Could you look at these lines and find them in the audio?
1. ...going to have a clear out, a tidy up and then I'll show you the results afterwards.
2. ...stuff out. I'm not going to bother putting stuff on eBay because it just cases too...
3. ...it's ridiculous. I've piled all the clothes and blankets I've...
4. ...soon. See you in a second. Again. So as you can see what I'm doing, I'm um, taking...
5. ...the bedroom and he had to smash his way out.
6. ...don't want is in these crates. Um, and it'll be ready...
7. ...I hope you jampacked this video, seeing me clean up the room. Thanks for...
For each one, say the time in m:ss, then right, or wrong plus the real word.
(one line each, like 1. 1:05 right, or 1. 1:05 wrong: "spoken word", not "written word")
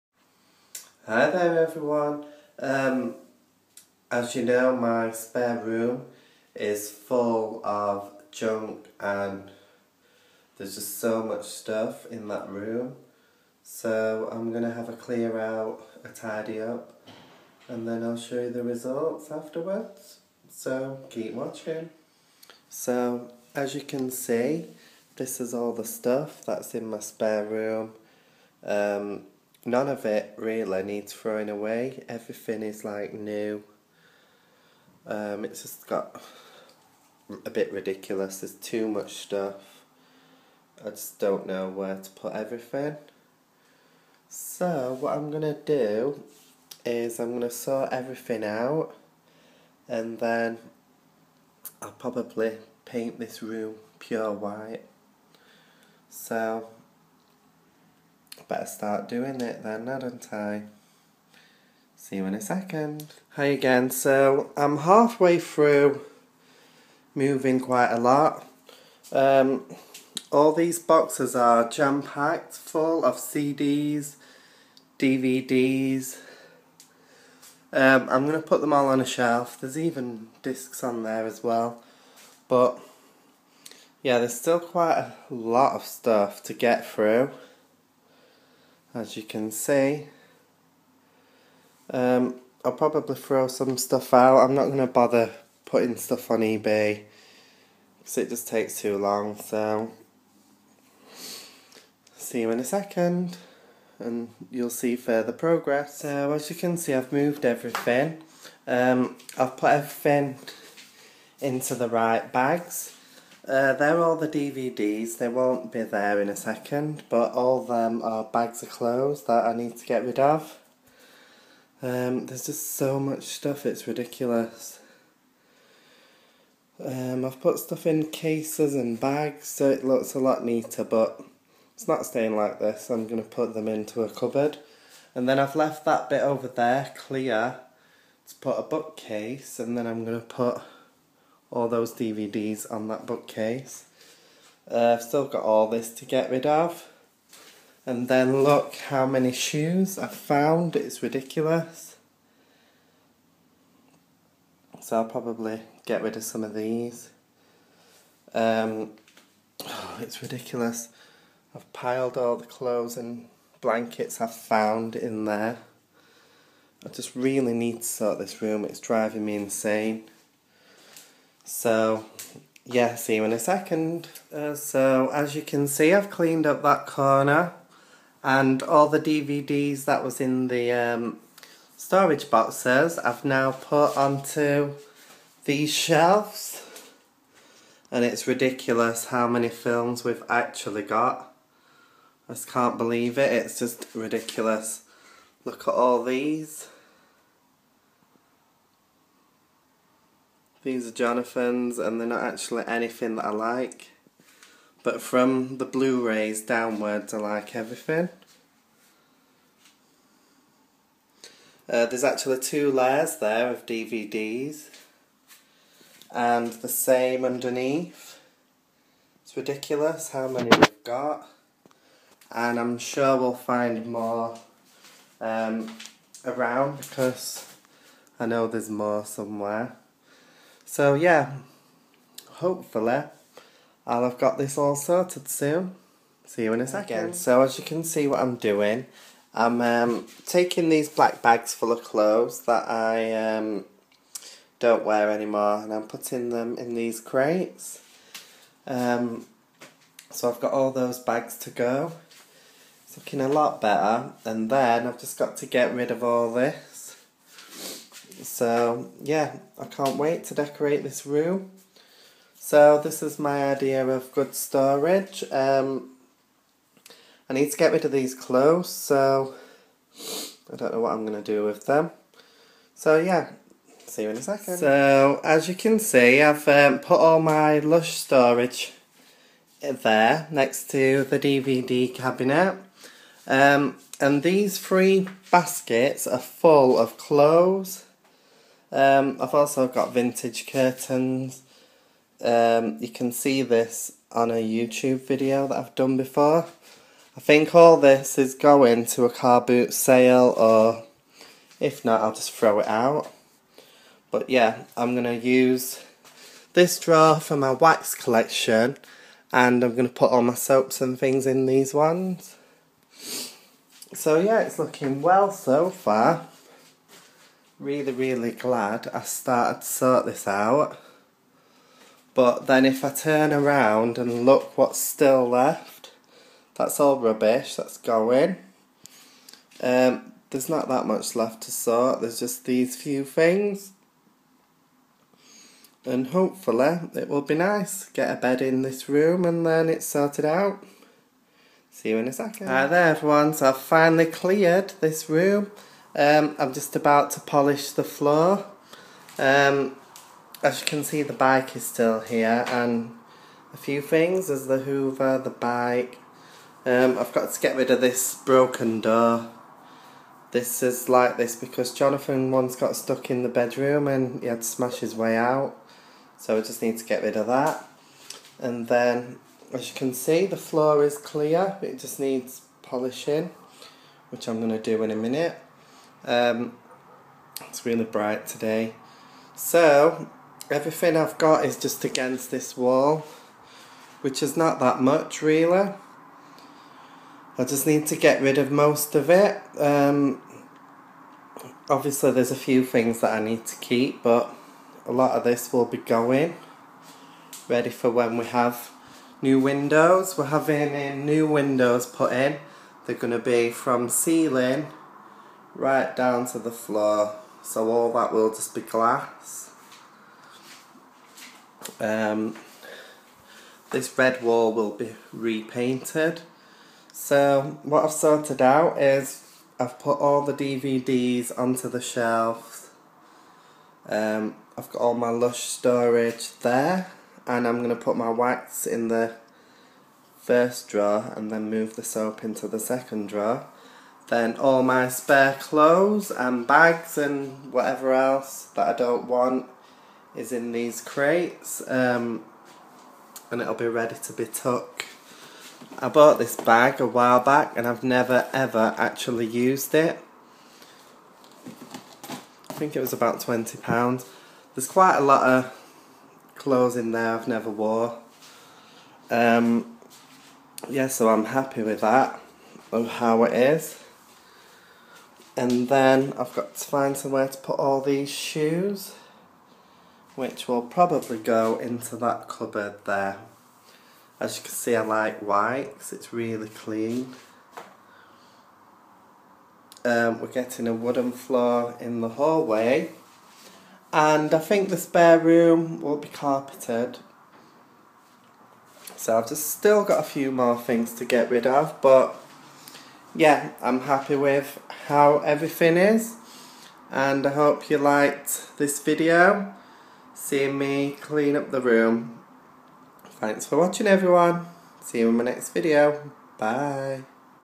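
1. 0:14 right
2. 1:33 wrong: "takes", not "cases"
3. 2:40 right
4. 3:55 right
5. 6:03 right
6. 7:18 right
7. 8:17 wrong: "liked", not "jampacked".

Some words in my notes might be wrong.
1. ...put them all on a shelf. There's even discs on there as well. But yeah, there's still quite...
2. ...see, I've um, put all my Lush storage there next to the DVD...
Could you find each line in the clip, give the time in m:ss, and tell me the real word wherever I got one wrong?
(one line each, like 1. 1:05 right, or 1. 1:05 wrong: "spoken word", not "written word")
1. 1:18 right
2. 4:35 right.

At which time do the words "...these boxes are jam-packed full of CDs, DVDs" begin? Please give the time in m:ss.
1:10.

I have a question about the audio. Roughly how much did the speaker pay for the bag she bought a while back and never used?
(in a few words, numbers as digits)
£20.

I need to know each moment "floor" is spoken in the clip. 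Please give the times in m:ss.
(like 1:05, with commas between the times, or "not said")
5:47, 6:10, 6:46, 8:01.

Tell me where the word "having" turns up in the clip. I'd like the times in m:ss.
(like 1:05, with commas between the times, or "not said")
6:40.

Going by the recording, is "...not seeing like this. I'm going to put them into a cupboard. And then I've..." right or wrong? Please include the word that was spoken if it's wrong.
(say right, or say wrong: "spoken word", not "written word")
wrong: "staying", not "seeing".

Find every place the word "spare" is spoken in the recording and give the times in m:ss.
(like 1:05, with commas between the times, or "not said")
0:05, 0:27, 7:14, 8:04.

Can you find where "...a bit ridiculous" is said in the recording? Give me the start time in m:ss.
0:37.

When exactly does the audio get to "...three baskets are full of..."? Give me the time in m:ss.
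4:44.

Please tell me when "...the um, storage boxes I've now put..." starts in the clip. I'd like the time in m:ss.
3:00.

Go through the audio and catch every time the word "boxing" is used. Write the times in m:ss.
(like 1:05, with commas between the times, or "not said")
not said.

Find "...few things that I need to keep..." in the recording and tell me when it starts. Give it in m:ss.
6:32.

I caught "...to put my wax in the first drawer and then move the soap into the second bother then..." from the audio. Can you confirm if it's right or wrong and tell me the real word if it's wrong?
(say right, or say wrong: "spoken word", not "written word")
wrong: "drawer", not "bother".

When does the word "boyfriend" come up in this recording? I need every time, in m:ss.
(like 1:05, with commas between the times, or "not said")
not said.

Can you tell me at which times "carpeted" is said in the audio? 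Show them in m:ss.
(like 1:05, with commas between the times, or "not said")
8:06.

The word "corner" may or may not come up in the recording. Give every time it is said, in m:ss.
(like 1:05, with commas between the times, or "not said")
2:56.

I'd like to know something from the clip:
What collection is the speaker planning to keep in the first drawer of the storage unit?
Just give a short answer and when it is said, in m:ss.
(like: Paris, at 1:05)
wax collection, at 5:07.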